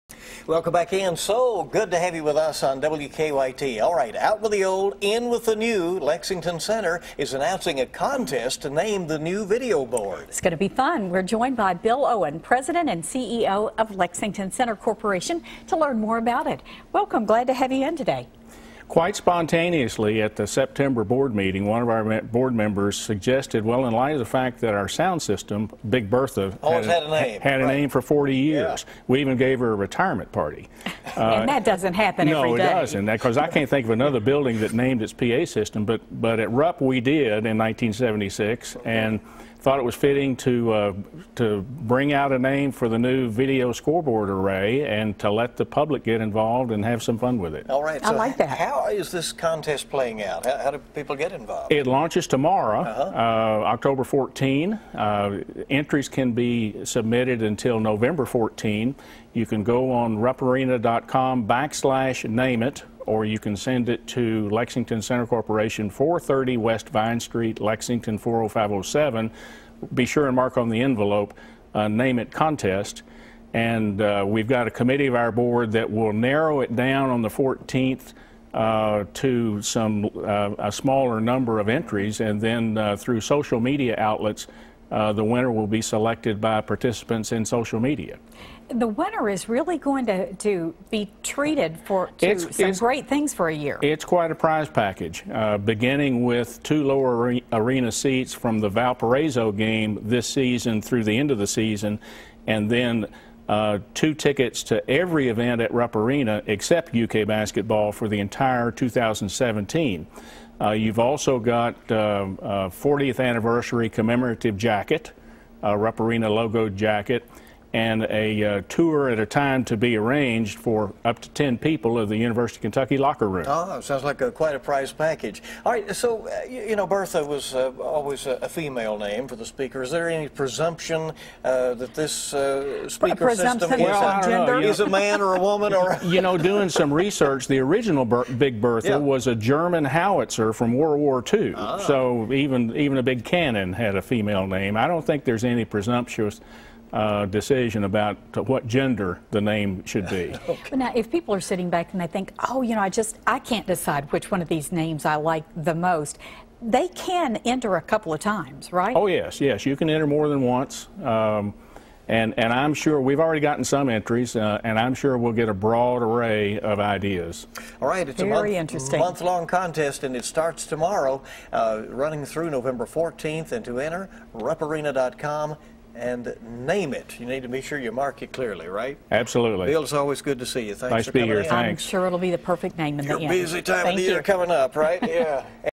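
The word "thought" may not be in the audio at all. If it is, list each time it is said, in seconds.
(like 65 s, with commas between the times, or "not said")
39 s.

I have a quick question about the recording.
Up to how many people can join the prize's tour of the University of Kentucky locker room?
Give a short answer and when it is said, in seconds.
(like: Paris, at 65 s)
10, at 121 s.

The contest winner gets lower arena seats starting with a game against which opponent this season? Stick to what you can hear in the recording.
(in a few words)
Valparaiso.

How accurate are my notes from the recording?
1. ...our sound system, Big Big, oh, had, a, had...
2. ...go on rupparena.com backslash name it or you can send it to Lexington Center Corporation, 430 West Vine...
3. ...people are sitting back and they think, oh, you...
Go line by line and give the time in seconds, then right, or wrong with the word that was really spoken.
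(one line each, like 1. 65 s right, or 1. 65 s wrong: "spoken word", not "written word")
1. 24 s wrong: "Bertha", not "Big"
2. 59 s right
3. 151 s right.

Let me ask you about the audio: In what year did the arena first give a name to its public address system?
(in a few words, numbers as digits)
1976.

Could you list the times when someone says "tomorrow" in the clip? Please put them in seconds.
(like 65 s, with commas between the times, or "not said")
52 s, 170 s.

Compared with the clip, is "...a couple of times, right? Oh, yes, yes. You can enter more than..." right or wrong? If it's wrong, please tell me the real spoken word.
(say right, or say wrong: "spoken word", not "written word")
right.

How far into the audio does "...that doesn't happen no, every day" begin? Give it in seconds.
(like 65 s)
31 s.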